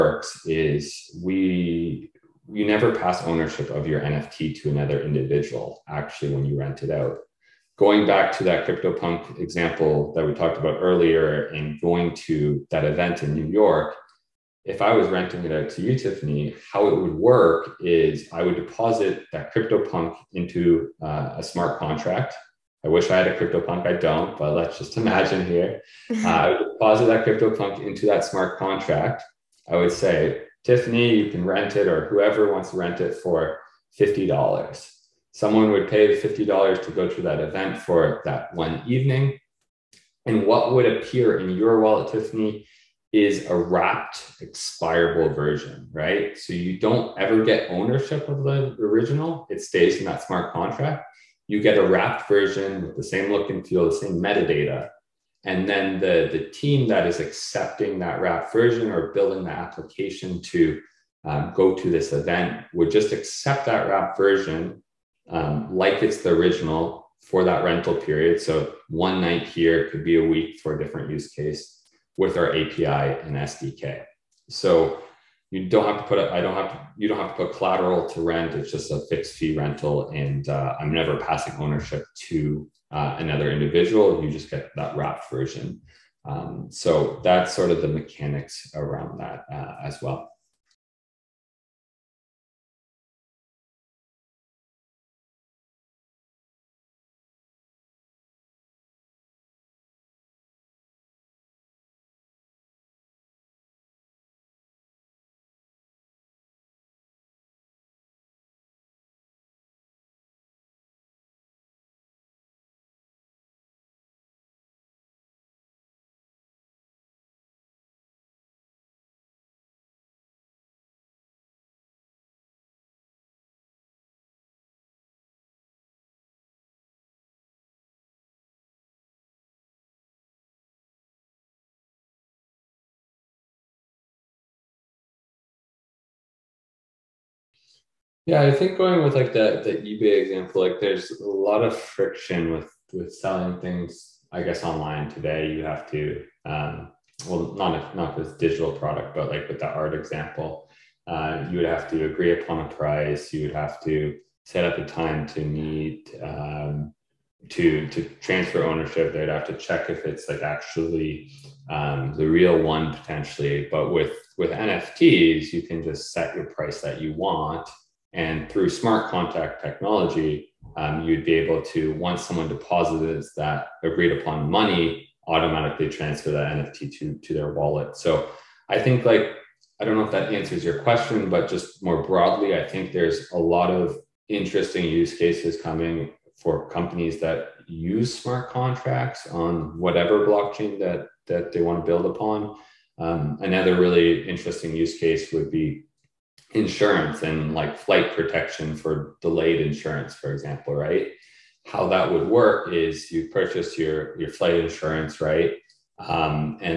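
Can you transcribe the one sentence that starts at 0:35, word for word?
Someone would pay $50 to go to that event for that one evening.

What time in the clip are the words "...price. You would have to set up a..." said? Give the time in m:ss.
2:32.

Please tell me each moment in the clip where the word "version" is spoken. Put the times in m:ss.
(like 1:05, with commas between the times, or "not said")
0:45, 0:52, 0:58, 1:04, 1:25.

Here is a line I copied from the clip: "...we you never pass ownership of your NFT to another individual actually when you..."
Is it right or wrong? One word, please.
right.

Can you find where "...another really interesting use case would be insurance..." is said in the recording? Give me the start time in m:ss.
3:13.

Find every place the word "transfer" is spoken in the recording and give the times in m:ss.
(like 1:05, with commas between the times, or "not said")
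2:38, 2:55.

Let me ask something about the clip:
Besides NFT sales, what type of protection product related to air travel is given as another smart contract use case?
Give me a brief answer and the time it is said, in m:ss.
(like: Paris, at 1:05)
flight insurance, at 3:24.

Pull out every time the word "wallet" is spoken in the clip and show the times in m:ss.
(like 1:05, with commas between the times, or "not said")
0:41, 2:57.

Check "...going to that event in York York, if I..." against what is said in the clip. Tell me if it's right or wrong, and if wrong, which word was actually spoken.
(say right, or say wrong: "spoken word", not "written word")
wrong: "New", not "York".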